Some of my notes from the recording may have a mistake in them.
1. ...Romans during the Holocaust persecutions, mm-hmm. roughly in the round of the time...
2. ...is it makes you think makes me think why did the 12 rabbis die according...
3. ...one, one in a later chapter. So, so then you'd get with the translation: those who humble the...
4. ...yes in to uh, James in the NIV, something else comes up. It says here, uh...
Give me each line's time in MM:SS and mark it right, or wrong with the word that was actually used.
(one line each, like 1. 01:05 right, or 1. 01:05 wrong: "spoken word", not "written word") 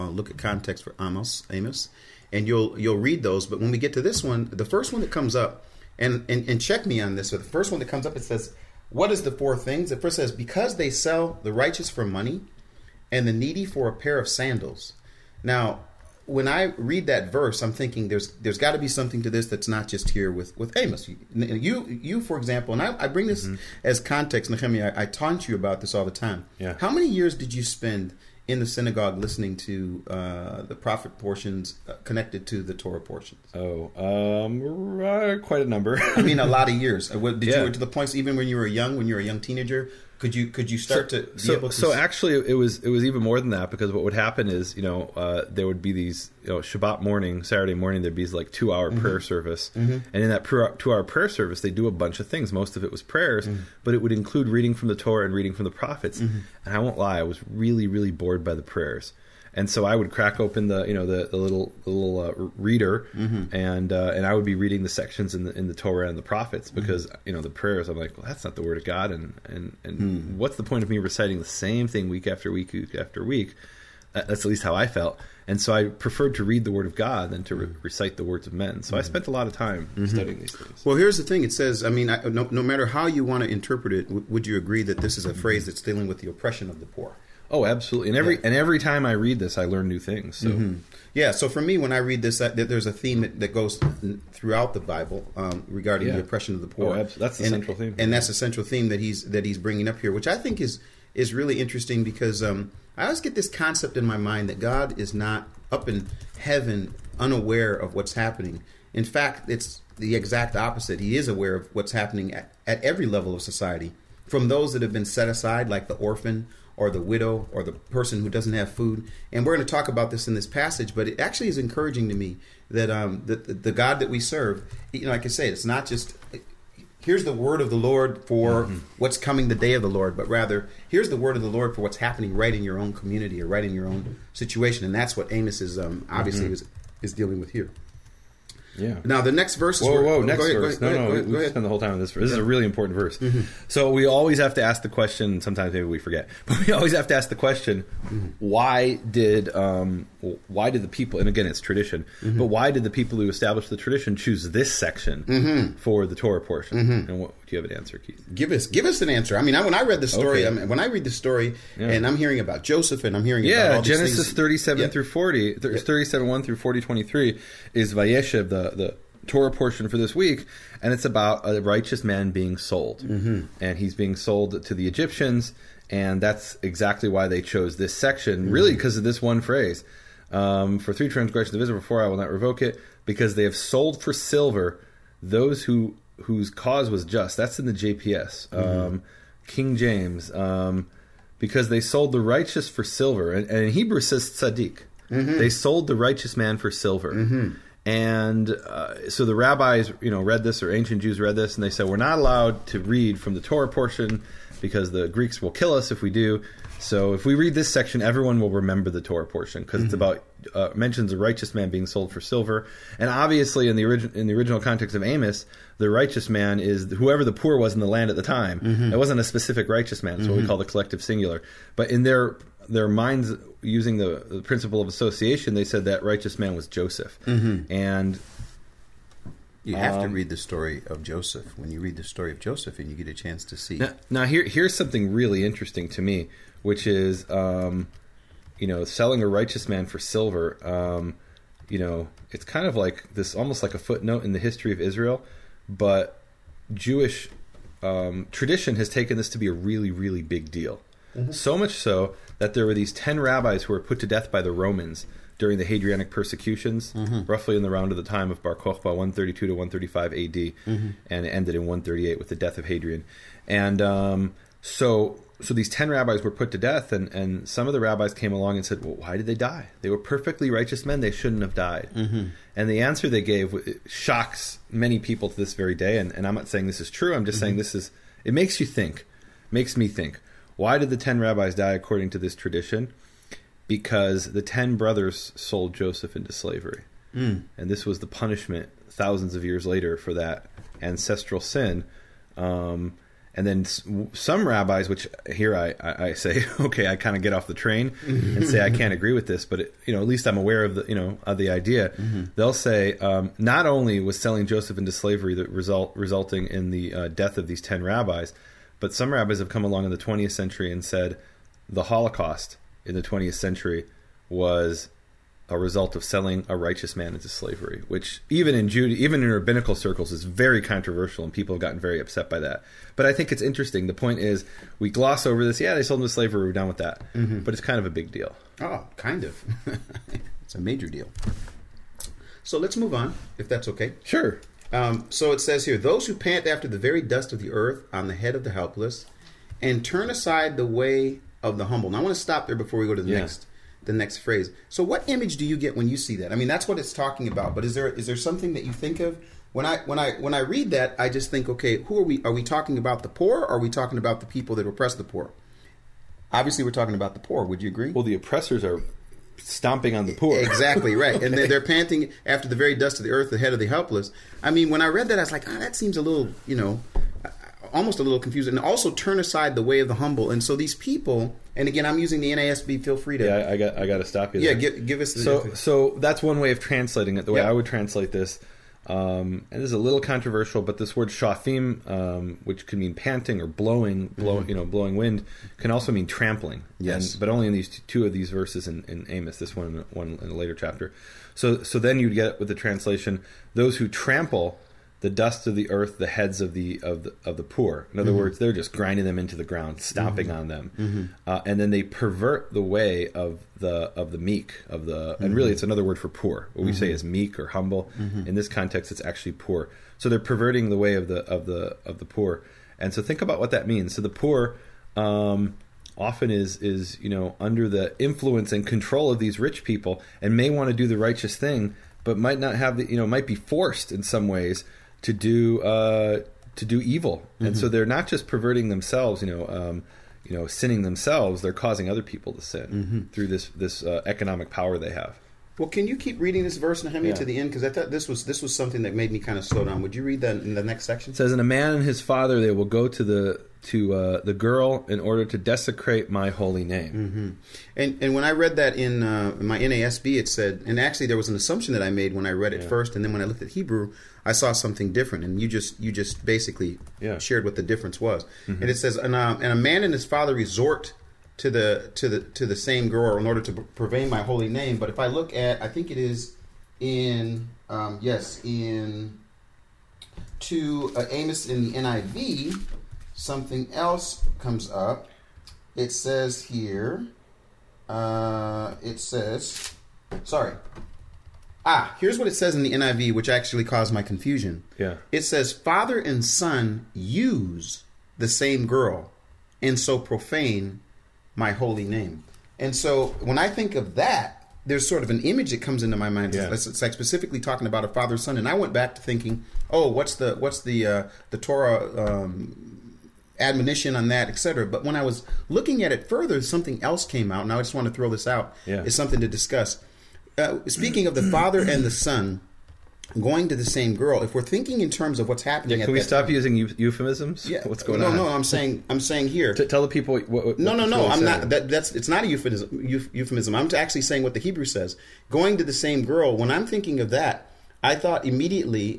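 1. 04:14 wrong: "Hadrianic", not "Holocaust"
2. 04:37 wrong: "10", not "12"
3. 06:29 wrong: "trample", not "humble"
4. 07:48 wrong: "Amos", not "James".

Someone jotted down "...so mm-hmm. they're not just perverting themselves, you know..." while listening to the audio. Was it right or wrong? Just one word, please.
right.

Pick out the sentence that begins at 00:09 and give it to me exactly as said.
It first says, because they sell the righteous for money and the needy for a pair of sandals.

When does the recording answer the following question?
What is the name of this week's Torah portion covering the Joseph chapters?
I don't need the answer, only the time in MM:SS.
02:47.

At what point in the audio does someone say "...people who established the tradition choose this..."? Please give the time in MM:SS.
02:32.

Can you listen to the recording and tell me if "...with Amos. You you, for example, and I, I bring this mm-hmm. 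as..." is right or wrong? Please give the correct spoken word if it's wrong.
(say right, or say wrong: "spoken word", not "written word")
right.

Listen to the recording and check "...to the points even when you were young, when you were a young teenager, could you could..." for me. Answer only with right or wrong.
right.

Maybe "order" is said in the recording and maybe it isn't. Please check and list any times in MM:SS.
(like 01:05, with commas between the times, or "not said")
07:24, 07:43.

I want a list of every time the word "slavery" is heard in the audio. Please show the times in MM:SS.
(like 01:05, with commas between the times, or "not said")
04:46, 05:04, 05:17, 05:26.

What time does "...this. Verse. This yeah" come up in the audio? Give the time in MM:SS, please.
02:21.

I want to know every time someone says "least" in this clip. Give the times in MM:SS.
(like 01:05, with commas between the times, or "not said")
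01:14, 05:00.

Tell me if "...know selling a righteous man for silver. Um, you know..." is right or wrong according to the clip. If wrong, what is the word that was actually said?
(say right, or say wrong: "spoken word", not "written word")
right.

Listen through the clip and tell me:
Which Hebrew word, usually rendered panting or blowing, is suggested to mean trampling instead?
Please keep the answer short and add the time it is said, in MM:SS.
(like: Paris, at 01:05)
Shafim, at 06:21.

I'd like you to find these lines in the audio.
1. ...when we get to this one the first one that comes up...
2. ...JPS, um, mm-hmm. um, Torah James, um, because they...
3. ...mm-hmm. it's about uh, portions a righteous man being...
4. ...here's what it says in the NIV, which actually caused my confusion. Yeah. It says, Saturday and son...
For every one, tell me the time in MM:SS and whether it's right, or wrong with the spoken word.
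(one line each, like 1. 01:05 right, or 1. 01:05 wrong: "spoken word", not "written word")
1. 00:03 right
2. 03:07 wrong: "King", not "Torah"
3. 03:29 wrong: "mentions", not "portions"
4. 08:01 wrong: "Father", not "Saturday".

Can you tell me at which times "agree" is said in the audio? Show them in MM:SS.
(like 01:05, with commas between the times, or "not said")
01:24, 04:58, 05:57.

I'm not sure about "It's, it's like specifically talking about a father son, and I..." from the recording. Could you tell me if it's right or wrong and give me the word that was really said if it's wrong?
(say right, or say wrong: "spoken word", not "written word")
right.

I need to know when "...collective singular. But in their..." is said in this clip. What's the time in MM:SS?
03:40.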